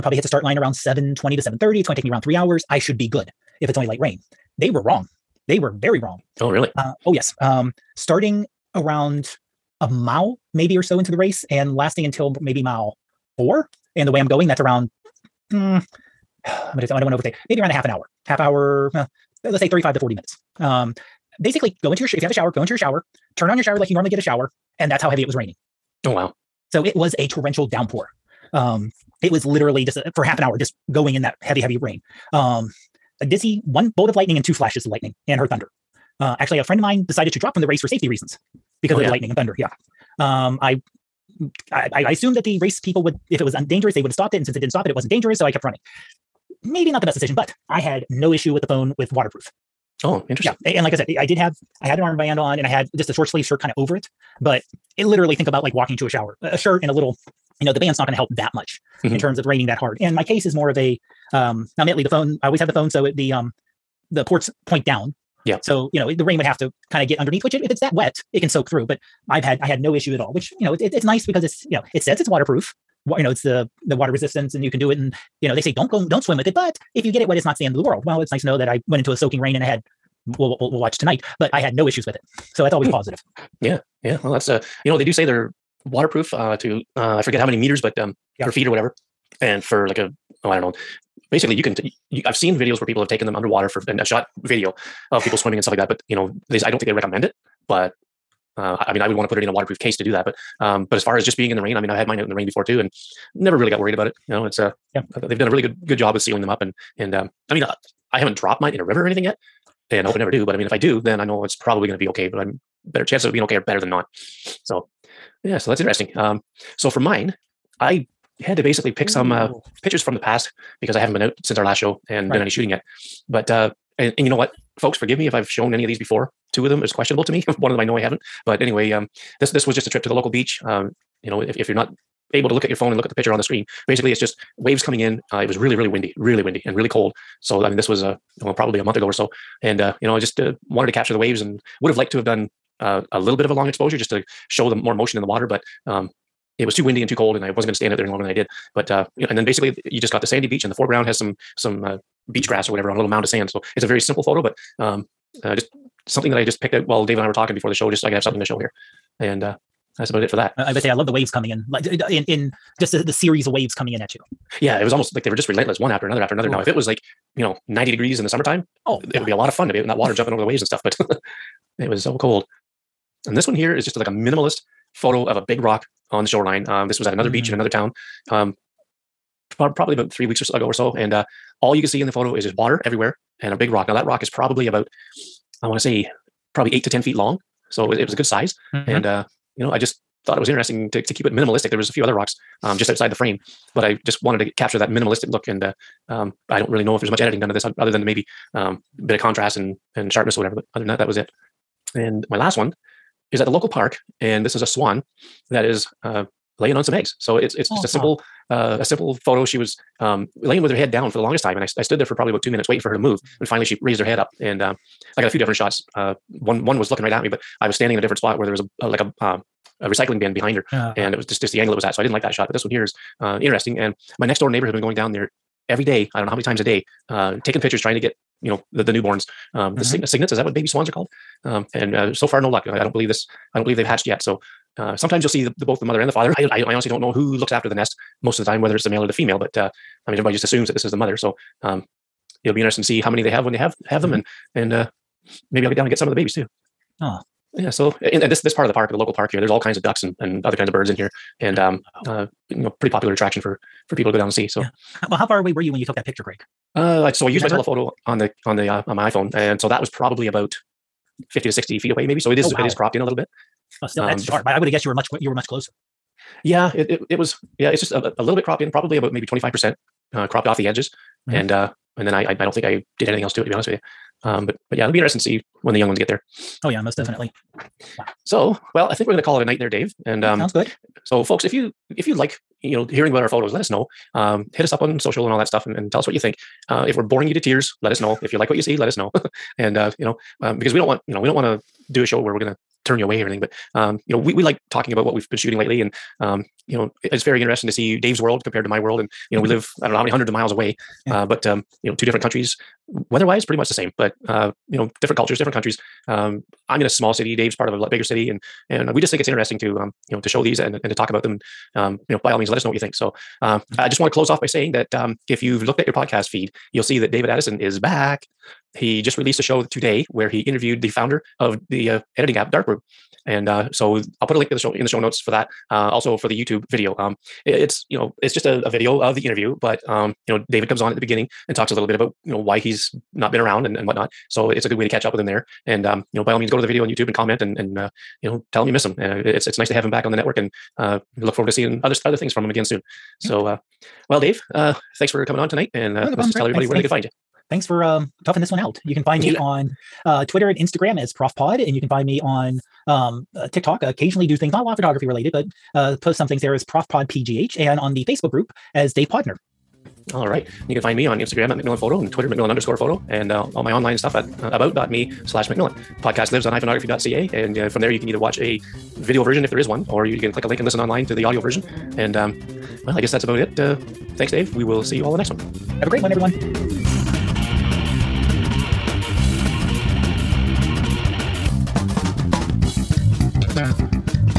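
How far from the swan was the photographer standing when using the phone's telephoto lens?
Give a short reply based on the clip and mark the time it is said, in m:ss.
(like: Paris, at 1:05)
50 to 60 feet, at 4:21.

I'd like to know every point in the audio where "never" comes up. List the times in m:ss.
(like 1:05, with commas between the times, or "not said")
1:43, 1:50.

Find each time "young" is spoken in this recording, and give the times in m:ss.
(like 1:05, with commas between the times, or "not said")
4:35.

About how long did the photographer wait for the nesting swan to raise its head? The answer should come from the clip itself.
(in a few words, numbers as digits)
2 minutes.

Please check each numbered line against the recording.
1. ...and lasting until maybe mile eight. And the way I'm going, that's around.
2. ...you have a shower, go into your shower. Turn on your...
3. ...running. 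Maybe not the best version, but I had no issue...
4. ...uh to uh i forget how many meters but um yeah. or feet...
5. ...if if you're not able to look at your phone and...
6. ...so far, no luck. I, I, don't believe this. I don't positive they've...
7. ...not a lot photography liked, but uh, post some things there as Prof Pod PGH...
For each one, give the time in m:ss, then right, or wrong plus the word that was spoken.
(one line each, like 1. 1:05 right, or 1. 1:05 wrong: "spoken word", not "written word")
1. 0:11 wrong: "four", not "eight"
2. 0:22 right
3. 0:45 wrong: "decision", not "version"
4. 1:26 right
5. 2:11 right
6. 3:52 wrong: "believe", not "positive"
7. 5:54 wrong: "related", not "liked".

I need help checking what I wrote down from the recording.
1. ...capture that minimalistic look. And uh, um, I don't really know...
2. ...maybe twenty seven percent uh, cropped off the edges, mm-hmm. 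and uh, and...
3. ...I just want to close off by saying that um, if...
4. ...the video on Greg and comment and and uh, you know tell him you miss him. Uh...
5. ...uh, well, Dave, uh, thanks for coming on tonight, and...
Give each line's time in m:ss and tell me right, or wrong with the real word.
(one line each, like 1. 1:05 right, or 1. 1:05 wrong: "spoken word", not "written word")
1. 3:14 right
2. 4:29 wrong: "five", not "seven"
3. 5:13 right
4. 5:36 wrong: "YouTube", not "Greg"
5. 5:43 right.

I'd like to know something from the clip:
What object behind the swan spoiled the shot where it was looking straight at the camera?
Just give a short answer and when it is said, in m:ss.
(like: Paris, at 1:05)
Recycling bin, at 3:39.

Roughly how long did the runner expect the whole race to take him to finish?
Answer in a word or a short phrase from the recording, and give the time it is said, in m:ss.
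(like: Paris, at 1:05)
3 hours, at 0:02.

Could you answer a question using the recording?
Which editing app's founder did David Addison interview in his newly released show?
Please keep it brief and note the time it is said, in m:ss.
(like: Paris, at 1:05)
Darkroom, at 5:22.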